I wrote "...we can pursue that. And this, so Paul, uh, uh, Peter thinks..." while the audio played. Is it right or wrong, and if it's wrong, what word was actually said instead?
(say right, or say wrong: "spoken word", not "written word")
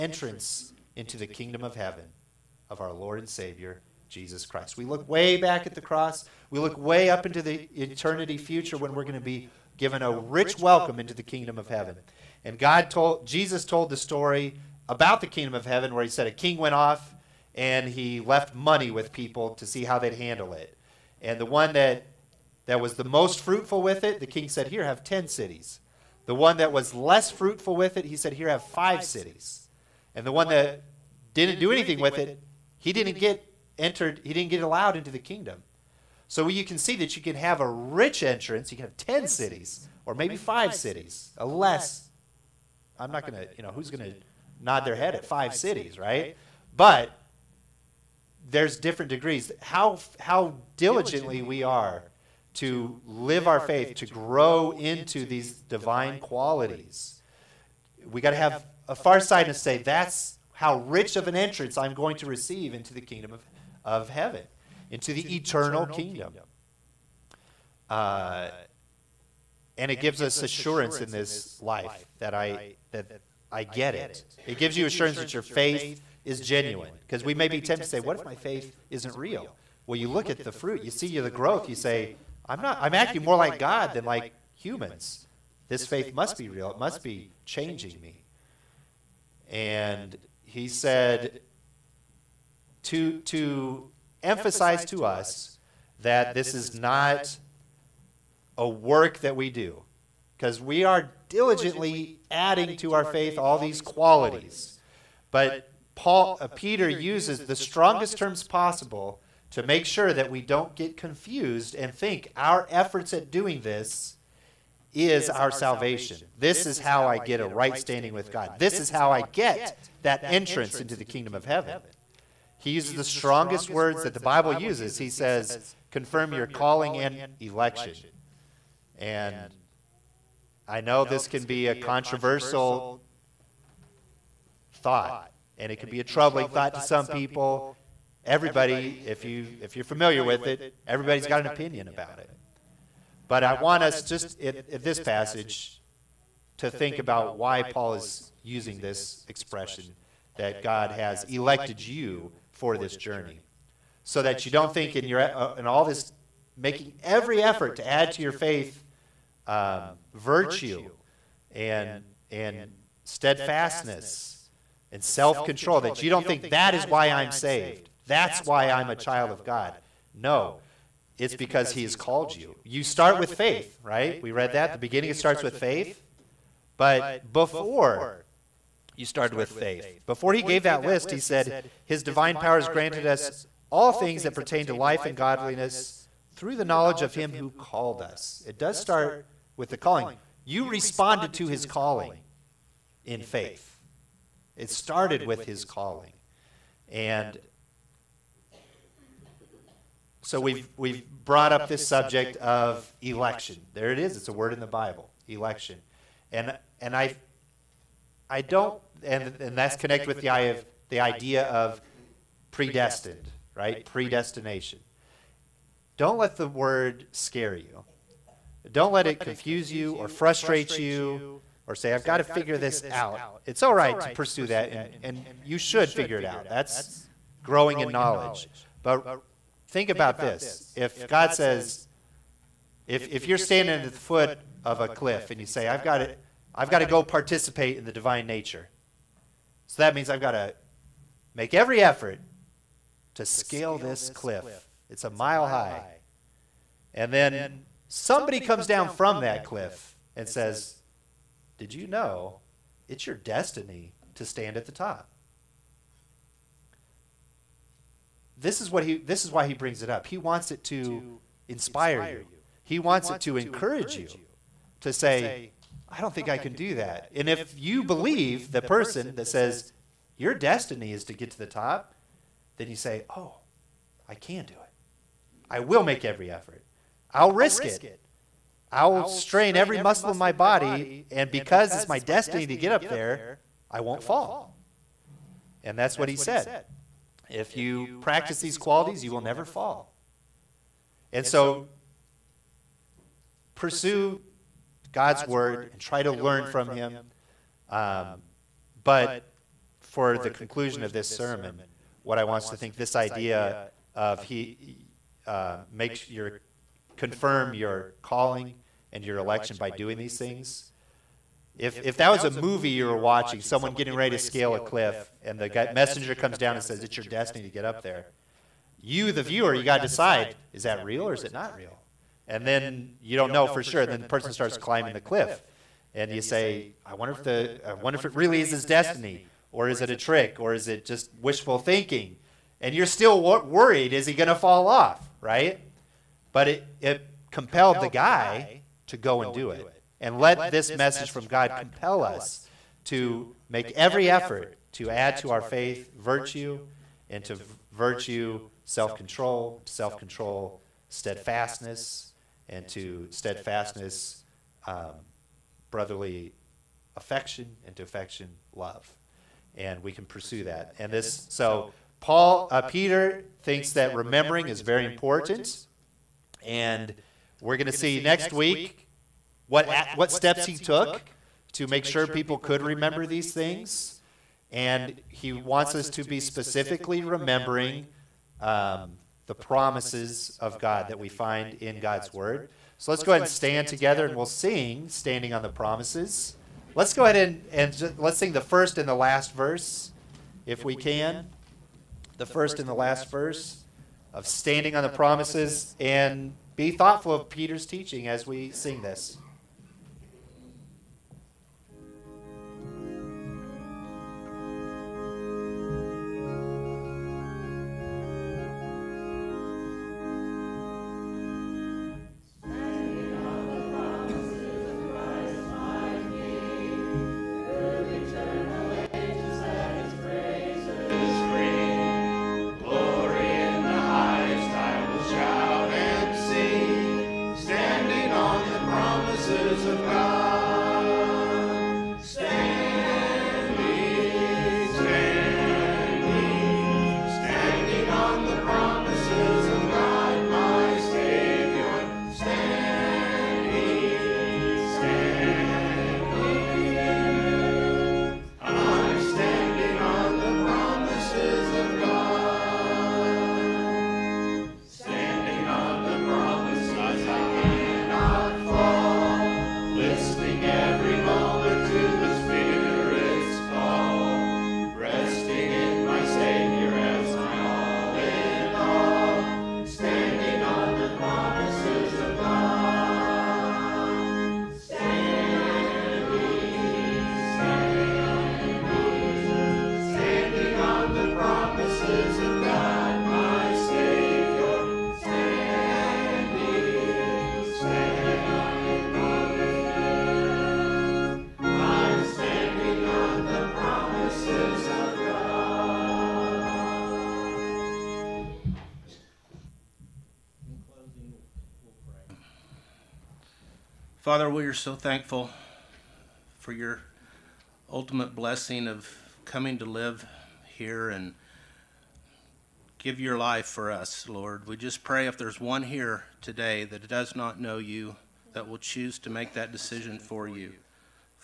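right.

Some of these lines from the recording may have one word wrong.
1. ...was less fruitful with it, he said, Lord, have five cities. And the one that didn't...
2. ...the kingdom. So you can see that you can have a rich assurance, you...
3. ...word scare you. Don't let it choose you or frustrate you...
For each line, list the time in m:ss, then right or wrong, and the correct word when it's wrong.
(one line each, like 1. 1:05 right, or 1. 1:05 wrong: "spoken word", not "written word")
1. 0:26 wrong: "Here", not "Lord"
2. 0:35 wrong: "entrance", not "assurance"
3. 3:36 wrong: "confuse", not "choose".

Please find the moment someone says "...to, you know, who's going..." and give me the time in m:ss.
0:43.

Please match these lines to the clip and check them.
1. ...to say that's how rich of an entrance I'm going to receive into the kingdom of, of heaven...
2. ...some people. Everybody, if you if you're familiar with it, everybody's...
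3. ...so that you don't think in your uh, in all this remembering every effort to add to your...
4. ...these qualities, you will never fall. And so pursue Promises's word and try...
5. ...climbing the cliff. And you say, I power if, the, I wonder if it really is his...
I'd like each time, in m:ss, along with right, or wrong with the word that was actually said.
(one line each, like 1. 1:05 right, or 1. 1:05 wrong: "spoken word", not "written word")
1. 0:59 right
2. 2:16 right
3. 2:34 wrong: "making", not "remembering"
4. 4:48 wrong: "God", not "Promises"
5. 5:24 wrong: "wonder", not "power".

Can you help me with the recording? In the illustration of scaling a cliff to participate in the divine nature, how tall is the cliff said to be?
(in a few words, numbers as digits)
a mile high.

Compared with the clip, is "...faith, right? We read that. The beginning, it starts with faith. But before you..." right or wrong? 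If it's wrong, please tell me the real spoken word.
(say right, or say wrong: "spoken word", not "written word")
right.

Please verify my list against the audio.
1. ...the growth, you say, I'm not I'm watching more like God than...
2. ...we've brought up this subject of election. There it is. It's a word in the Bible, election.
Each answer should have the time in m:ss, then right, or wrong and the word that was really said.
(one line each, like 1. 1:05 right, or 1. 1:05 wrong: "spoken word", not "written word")
1. 1:21 wrong: "acting", not "watching"
2. 3:20 right.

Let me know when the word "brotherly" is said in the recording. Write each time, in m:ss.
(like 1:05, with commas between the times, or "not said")
5:55.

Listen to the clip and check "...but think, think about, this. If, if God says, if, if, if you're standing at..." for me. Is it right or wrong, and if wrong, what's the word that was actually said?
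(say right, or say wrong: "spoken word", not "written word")
right.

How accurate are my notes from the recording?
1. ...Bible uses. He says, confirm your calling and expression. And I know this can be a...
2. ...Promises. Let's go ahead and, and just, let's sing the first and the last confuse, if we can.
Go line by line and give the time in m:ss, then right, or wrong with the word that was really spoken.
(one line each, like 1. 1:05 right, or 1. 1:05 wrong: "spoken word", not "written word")
1. 2:04 wrong: "election", not "expression"
2. 6:25 wrong: "verse", not "confuse".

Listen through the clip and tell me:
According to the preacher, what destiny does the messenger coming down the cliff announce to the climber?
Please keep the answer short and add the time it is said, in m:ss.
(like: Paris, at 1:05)
to stand at the top, at 4:14.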